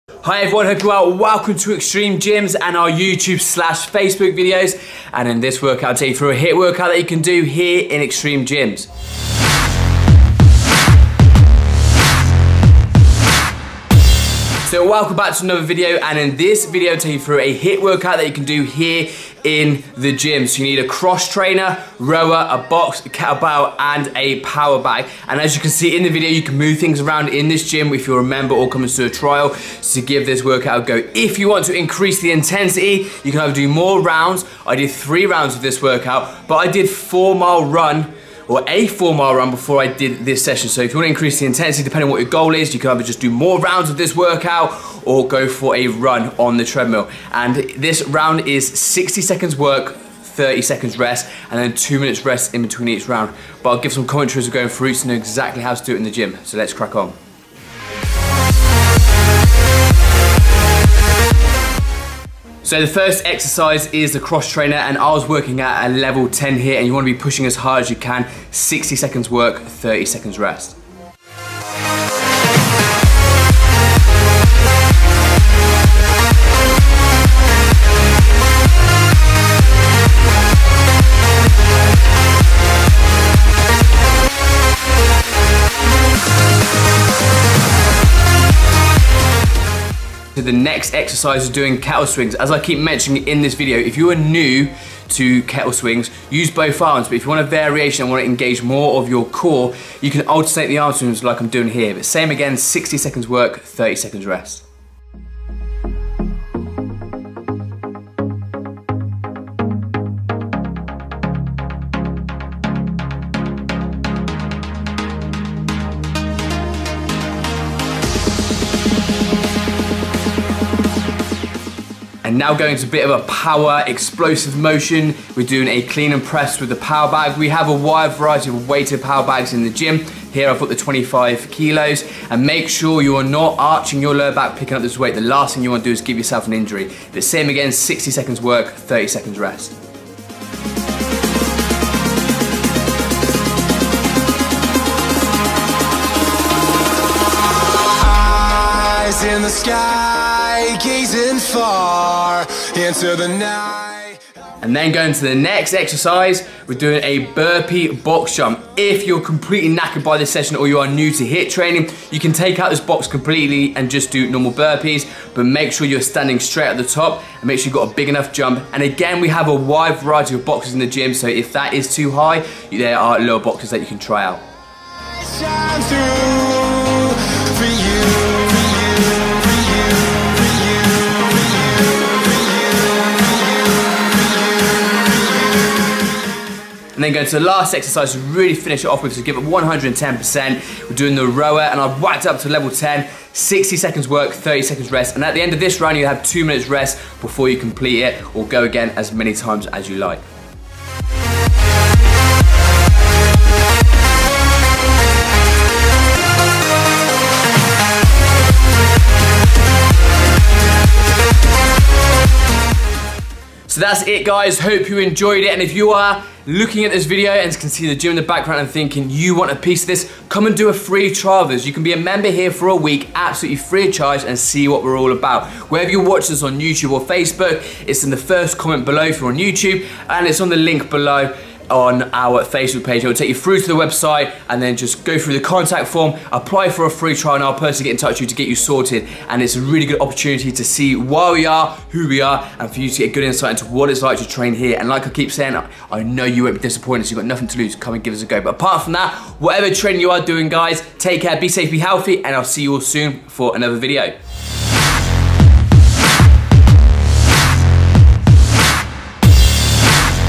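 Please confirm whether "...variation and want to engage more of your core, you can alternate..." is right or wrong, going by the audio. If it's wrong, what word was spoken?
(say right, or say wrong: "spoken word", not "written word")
right.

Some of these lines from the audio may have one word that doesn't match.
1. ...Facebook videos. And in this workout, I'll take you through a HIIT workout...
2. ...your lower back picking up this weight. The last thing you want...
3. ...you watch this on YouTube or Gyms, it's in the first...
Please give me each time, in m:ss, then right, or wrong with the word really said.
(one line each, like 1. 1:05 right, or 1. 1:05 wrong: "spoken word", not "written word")
1. 0:03 right
2. 2:14 right
3. 3:45 wrong: "Facebook", not "Gyms".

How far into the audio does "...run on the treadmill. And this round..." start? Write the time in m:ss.
0:45.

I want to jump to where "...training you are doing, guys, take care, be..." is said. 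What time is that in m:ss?
4:09.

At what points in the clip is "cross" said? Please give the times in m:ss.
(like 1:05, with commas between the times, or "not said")
0:20, 1:04.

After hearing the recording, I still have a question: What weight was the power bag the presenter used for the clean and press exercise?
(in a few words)
25 kilos.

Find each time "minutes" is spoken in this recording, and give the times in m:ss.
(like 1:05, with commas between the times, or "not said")
0:51, 3:16.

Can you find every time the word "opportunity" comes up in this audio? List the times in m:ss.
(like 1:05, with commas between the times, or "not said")
4:00.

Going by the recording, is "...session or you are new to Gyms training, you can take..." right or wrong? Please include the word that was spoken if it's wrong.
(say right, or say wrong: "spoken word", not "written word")
wrong: "HIIT", not "Gyms".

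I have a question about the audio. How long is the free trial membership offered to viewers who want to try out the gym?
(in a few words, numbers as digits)
A week.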